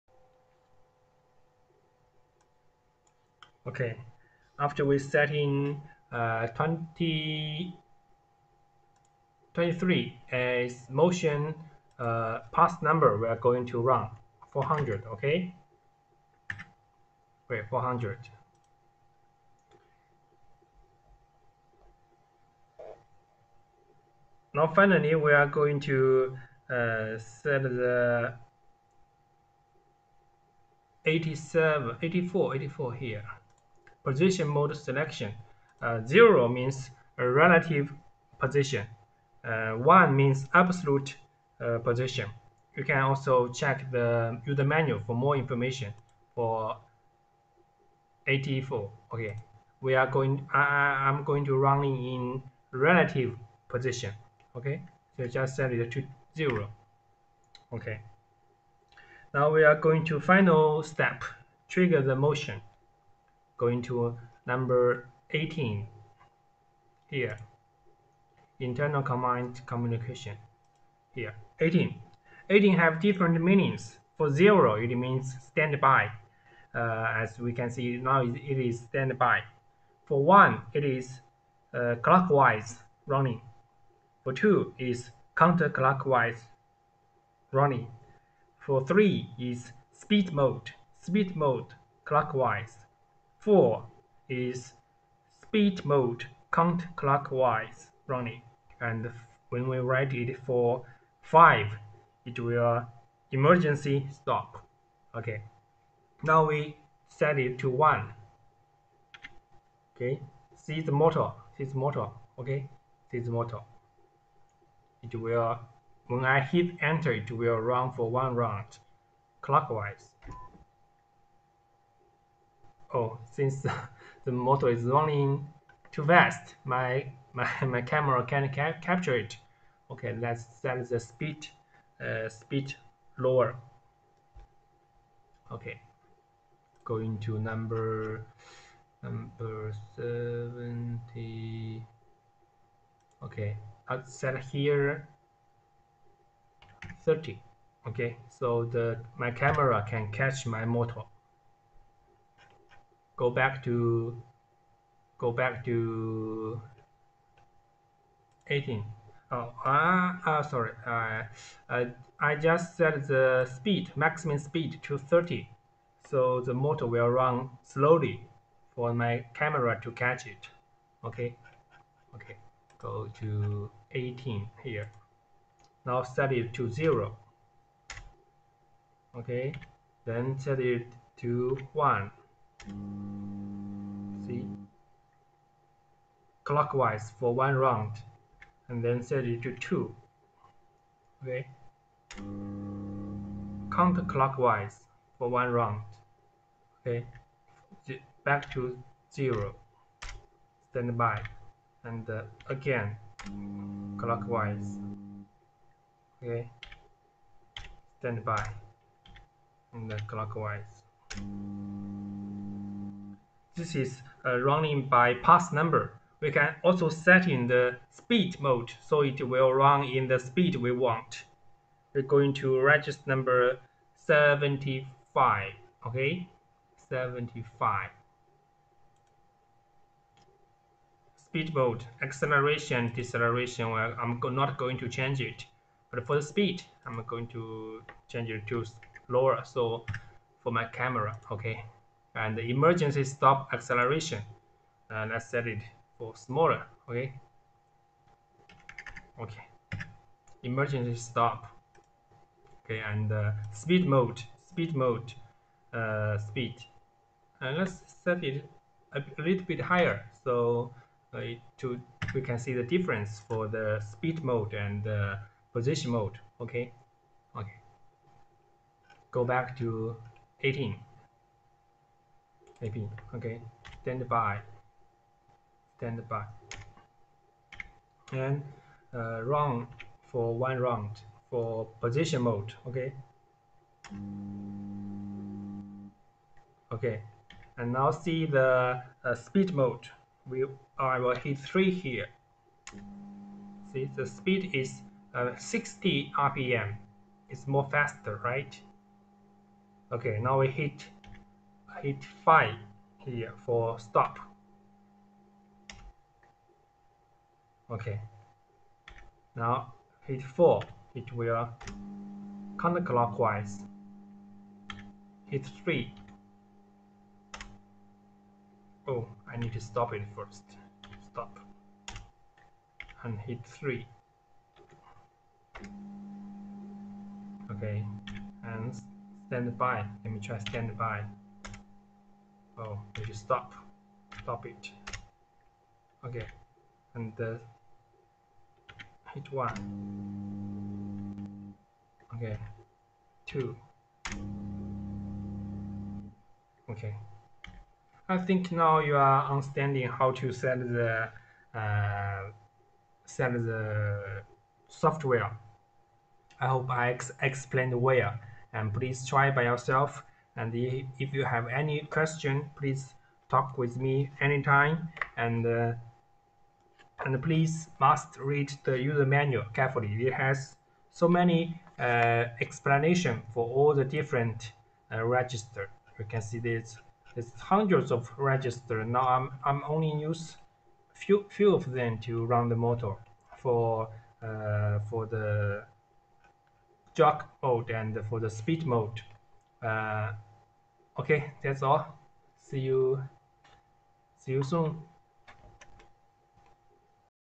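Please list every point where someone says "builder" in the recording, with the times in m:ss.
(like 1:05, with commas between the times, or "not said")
not said.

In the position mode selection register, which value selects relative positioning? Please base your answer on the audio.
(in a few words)
0.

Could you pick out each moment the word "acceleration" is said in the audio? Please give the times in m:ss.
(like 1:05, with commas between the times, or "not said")
3:52, 4:03.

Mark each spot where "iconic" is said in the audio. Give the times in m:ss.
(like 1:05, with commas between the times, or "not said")
not said.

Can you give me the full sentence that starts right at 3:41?
We're going to register number 75, okay?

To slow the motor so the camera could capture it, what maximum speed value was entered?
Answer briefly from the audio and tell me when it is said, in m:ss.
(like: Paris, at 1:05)
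30, at 2:23.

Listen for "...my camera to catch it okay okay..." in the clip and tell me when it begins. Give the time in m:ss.
2:49.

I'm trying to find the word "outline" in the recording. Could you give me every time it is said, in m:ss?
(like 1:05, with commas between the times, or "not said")
not said.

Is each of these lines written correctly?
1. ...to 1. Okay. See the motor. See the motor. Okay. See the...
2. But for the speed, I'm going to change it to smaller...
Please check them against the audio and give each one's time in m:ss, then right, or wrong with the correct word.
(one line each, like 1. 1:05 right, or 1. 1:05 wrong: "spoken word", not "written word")
1. 1:47 right
2. 3:55 wrong: "lower", not "smaller".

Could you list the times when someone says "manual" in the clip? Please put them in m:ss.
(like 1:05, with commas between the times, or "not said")
0:44, 6:09.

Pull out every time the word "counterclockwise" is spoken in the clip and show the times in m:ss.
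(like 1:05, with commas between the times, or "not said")
1:25, 1:36, 3:13, 5:12.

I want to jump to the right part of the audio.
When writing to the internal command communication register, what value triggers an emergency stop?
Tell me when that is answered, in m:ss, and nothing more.
1:41.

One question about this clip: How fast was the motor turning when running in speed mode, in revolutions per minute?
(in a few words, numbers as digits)
60 rpm.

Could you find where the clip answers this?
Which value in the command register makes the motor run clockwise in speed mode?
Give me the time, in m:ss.
1:28.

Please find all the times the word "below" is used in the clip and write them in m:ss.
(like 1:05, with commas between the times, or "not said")
not said.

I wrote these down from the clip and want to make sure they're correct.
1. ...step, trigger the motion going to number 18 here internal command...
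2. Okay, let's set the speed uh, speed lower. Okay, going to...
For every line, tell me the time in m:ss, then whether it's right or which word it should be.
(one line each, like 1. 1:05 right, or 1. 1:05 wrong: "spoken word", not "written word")
1. 1:00 right
2. 2:09 right.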